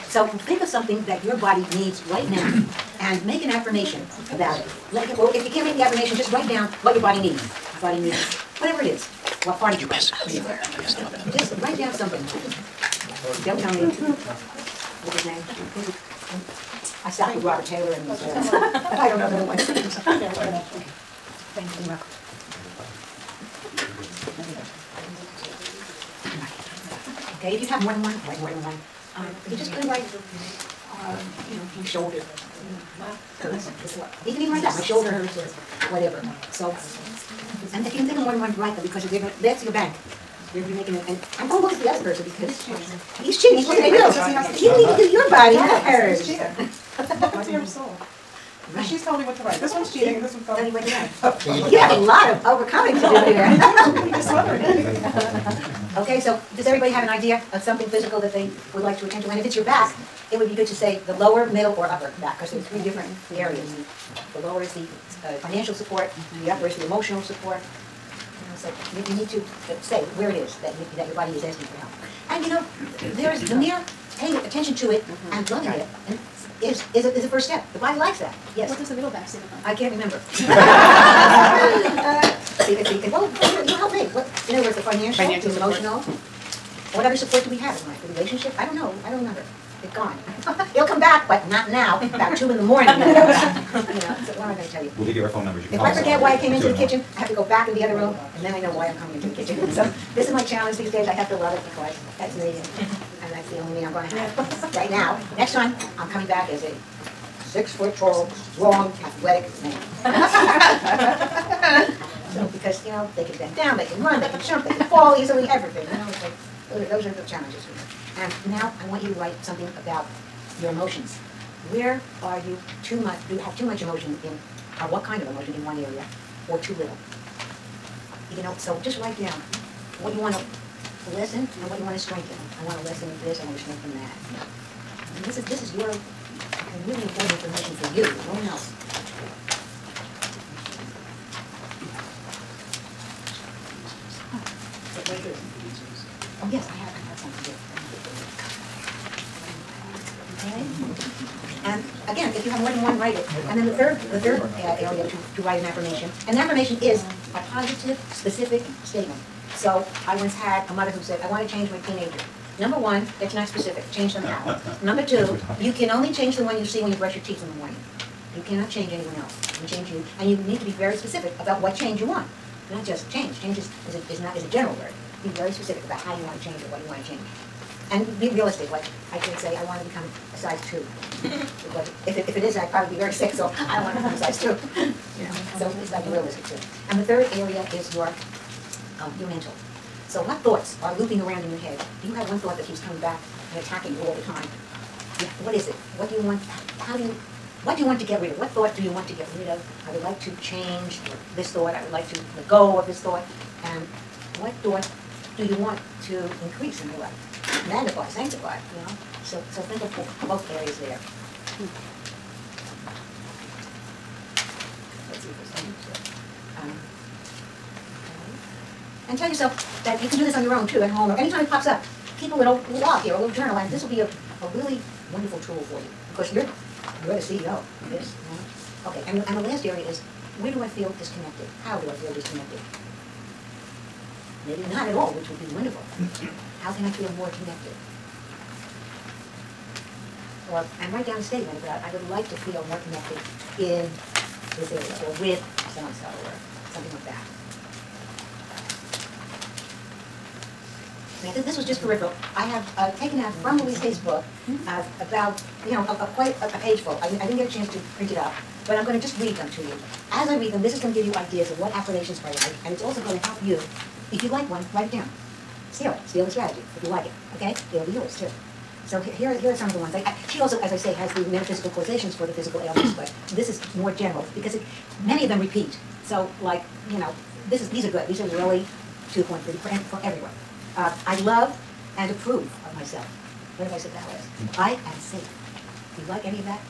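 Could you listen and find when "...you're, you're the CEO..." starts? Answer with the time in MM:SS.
03:46.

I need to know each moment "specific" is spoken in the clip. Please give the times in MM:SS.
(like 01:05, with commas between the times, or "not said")
02:38, 02:43, 02:50, 02:55.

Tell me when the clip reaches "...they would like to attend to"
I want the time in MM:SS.
00:58.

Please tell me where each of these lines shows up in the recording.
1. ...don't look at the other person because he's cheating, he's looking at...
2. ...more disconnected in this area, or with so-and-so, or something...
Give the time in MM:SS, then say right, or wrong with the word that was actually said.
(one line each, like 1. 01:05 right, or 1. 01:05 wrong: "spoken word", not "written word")
1. 00:41 right
2. 04:02 wrong: "connected", not "disconnected".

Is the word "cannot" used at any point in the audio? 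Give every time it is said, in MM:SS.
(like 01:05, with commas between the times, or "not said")
02:48.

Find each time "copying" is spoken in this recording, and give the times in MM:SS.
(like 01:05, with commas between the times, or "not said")
not said.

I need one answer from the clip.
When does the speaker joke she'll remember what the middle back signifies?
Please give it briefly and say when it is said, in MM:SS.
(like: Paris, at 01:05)
2 in the morning, at 01:32.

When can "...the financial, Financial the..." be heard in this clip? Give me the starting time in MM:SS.
01:24.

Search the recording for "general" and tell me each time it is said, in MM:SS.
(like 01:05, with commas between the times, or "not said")
02:54, 04:33.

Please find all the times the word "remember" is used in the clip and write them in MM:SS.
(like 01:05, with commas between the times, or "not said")
01:19, 01:29.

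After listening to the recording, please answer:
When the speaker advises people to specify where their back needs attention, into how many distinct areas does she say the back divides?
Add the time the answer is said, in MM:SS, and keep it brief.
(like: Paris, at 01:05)
3, at 01:02.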